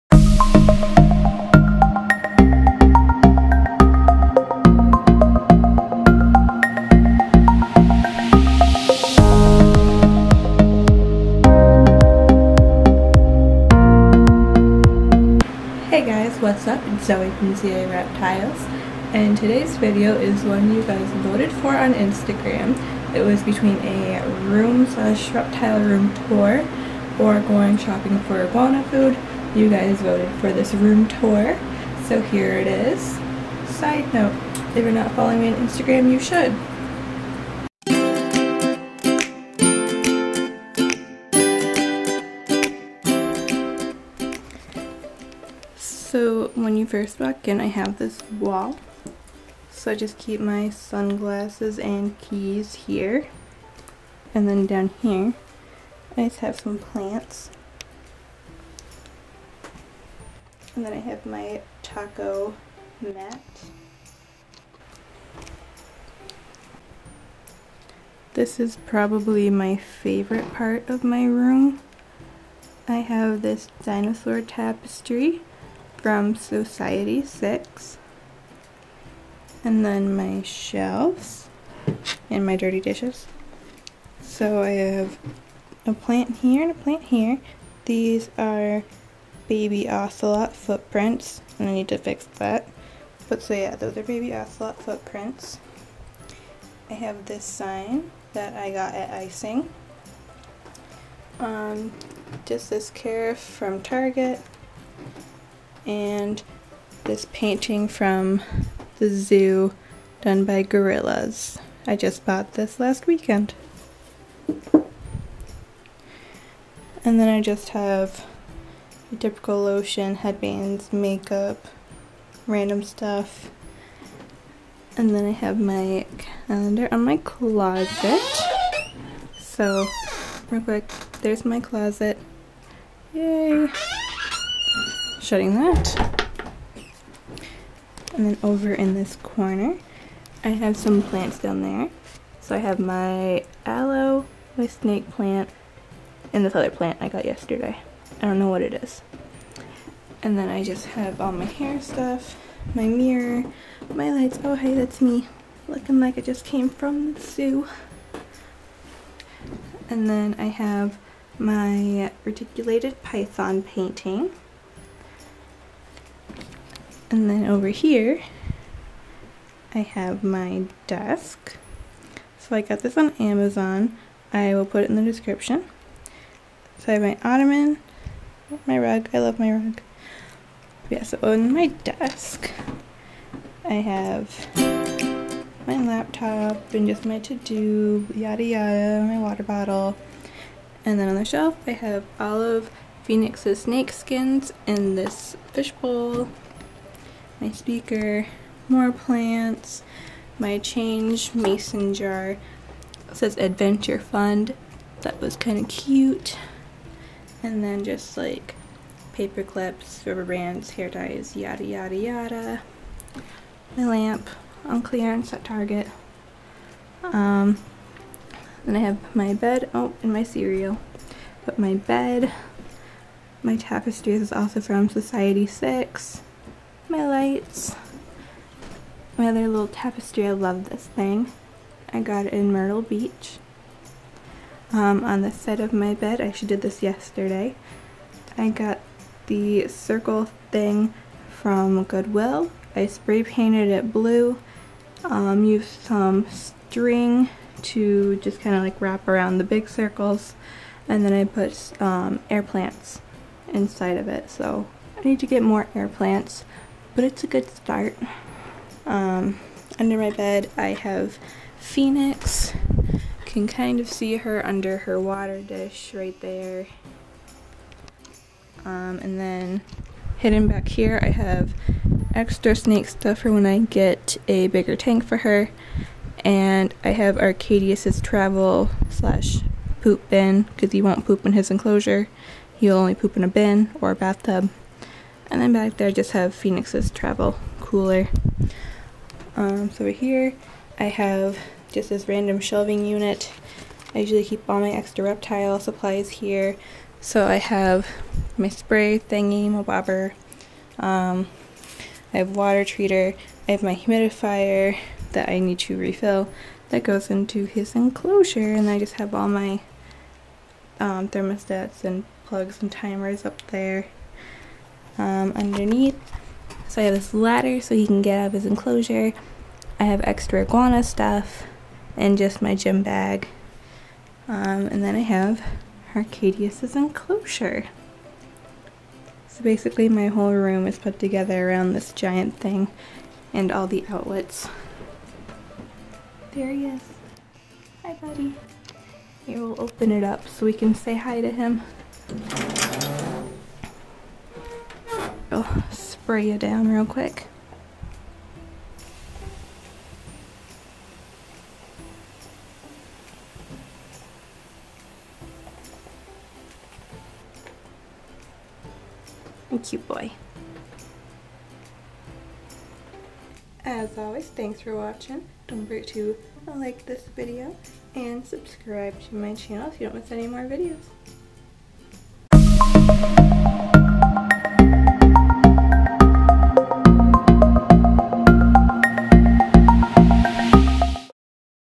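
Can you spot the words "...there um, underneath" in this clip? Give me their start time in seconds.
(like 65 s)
313 s.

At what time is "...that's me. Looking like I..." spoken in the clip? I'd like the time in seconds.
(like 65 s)
154 s.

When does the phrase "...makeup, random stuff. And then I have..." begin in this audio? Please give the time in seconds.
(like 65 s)
120 s.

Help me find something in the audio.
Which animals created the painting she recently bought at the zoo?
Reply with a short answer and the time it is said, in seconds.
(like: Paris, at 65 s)
gorillas, at 110 s.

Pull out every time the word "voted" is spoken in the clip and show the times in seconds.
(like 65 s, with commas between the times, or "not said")
21 s, 30 s.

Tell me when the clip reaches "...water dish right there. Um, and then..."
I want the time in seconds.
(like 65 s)
264 s.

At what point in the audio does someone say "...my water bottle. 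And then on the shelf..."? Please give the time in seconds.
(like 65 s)
189 s.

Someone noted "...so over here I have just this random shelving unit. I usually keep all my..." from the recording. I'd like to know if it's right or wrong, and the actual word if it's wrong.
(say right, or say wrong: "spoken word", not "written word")
right.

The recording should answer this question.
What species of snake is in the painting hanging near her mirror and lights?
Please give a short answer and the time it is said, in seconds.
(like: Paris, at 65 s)
reticulated python, at 162 s.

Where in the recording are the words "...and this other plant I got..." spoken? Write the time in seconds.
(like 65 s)
146 s.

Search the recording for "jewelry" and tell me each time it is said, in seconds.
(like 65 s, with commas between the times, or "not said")
not said.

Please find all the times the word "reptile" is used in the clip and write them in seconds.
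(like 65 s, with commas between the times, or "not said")
17 s, 25 s, 295 s.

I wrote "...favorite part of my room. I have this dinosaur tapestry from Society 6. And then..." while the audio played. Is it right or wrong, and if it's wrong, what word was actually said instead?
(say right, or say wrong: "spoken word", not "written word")
right.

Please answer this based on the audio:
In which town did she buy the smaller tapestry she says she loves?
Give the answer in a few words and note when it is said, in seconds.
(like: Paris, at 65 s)
Myrtle Beach, at 232 s.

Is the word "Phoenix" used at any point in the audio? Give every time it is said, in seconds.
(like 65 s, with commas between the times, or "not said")
193 s, 261 s, 286 s.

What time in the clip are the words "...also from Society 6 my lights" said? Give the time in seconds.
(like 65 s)
224 s.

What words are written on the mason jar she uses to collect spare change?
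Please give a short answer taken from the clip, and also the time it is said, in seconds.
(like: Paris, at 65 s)
Adventure Fund, at 203 s.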